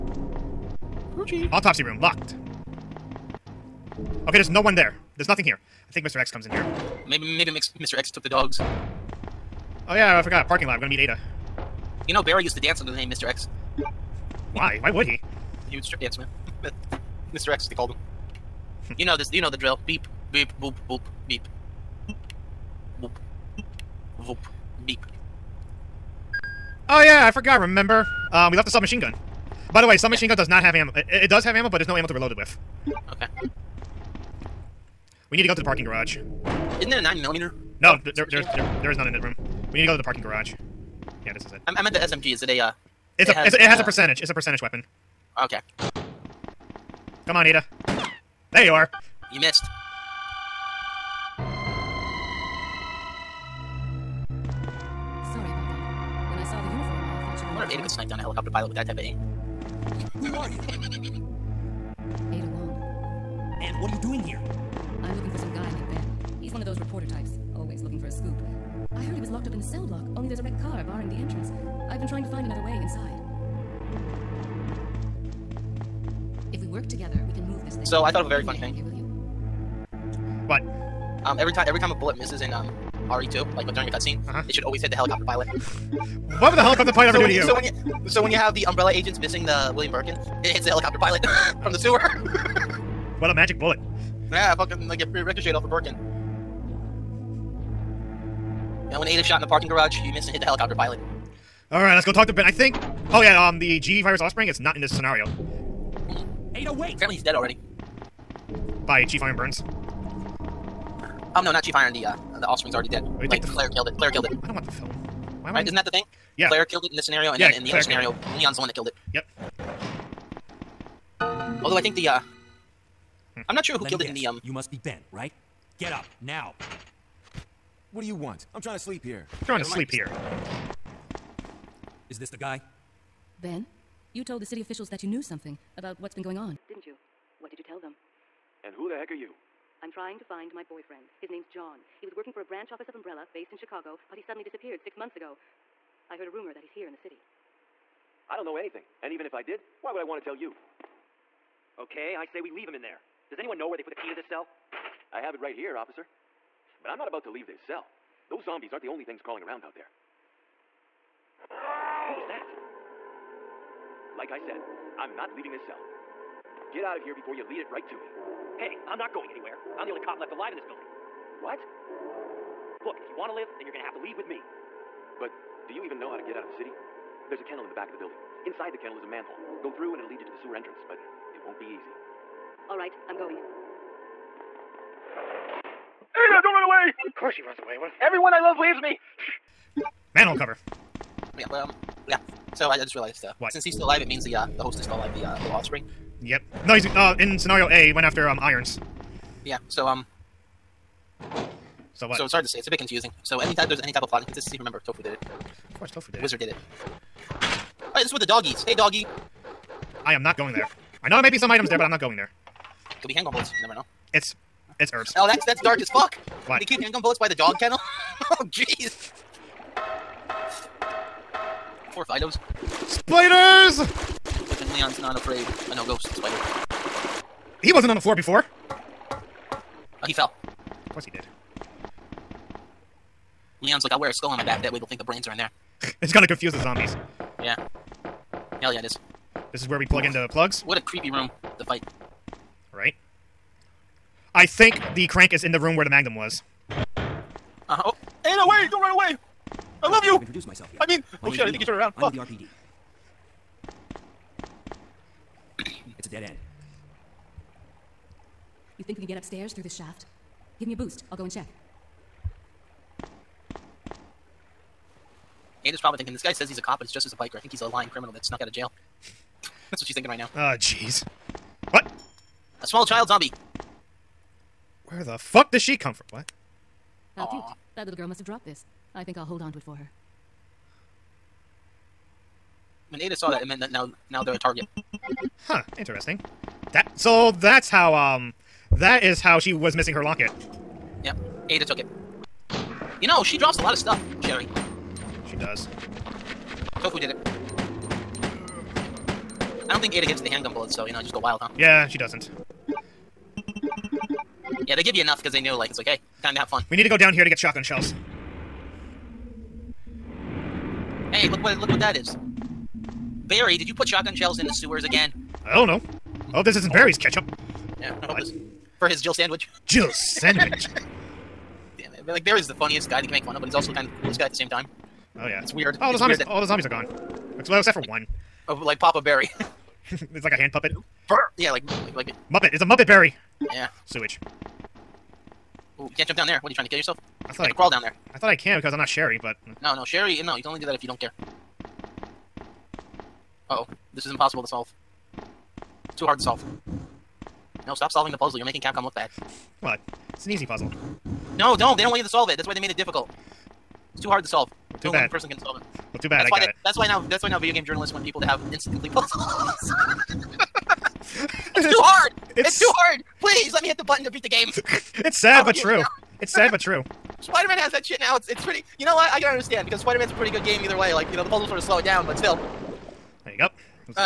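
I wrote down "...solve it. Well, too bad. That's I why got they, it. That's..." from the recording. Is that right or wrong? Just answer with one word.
right.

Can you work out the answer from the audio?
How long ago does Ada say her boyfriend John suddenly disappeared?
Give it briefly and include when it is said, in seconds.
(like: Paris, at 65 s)
6 months, at 144 s.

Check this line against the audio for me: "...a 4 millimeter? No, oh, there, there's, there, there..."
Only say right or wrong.
wrong.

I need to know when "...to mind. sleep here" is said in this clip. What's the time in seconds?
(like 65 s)
129 s.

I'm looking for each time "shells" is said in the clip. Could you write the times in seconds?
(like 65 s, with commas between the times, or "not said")
307 s, 314 s.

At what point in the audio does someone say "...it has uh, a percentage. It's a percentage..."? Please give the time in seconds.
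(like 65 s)
43 s.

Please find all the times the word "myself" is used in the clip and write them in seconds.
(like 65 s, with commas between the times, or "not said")
250 s.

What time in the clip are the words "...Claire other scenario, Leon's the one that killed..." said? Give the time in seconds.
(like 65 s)
117 s.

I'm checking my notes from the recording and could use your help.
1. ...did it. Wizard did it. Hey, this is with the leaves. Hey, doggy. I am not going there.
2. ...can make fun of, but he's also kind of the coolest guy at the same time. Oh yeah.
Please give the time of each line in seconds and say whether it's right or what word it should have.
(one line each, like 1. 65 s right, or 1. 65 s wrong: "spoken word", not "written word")
1. 206 s wrong: "doggies", not "leaves"
2. 323 s right.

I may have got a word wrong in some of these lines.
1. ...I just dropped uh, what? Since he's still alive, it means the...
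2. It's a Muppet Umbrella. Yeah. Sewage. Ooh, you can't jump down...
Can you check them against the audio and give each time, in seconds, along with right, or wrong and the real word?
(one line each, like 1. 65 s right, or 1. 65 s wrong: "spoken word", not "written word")
1. 192 s wrong: "realized", not "dropped"
2. 332 s wrong: "Barry", not "Umbrella".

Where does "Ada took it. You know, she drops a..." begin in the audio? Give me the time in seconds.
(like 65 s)
291 s.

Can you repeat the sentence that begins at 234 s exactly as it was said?
That way they'll think the brains are in there.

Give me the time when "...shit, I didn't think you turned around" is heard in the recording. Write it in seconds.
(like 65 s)
251 s.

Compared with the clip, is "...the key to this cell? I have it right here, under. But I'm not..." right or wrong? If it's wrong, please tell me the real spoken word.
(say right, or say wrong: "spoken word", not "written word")
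wrong: "officer", not "under".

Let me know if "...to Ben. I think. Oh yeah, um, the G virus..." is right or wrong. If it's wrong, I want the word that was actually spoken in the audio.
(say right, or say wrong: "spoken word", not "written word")
right.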